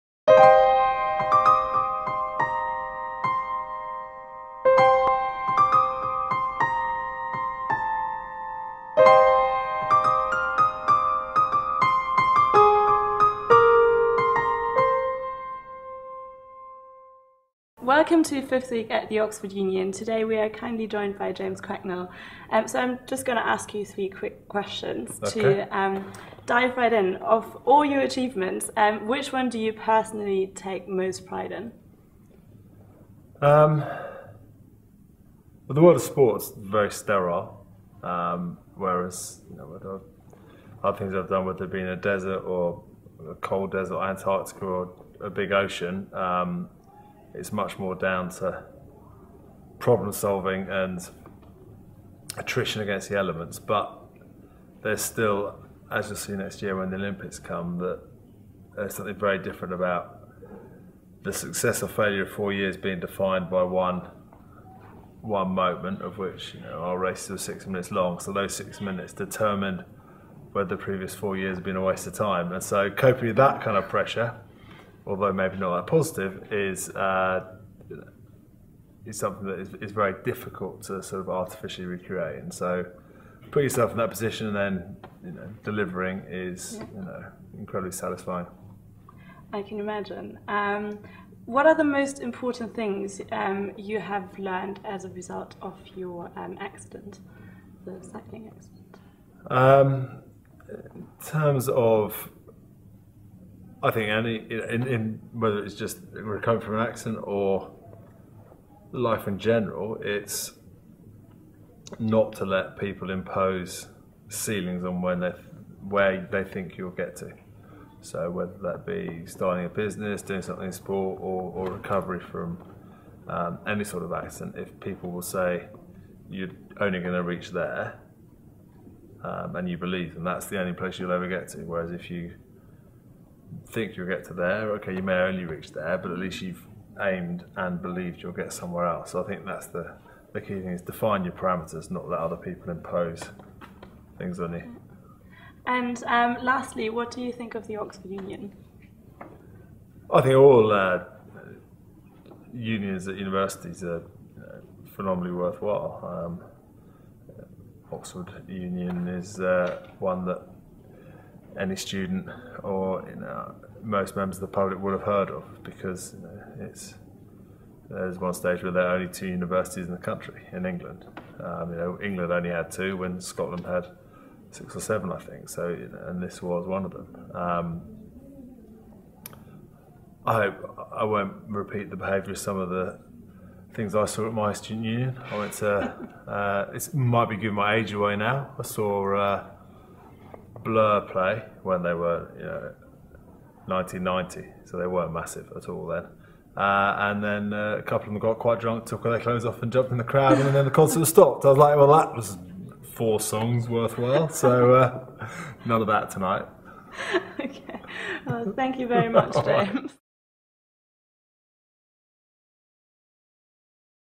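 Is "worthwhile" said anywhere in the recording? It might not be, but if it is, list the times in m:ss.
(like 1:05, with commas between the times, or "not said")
2:35, 3:23.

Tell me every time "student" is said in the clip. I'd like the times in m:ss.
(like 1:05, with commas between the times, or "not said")
2:41, 3:04.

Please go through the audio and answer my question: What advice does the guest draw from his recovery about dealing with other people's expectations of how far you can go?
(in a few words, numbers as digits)
Define your parameters.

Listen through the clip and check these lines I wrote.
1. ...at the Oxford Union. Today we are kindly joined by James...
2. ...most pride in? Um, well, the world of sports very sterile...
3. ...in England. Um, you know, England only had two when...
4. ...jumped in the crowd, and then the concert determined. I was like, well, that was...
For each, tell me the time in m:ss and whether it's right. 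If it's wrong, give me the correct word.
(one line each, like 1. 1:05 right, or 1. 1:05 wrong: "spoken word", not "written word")
1. 0:18 right
2. 0:30 right
3. 2:50 right
4. 3:19 wrong: "stopped", not "determined".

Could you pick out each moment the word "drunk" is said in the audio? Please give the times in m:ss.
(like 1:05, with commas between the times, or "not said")
3:18.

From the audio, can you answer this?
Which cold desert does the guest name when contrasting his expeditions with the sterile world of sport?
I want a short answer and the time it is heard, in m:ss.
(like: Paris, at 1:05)
Antarctica, at 0:44.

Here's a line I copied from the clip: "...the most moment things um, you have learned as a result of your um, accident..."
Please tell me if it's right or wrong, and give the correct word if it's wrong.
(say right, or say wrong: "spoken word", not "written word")
wrong: "important", not "moment".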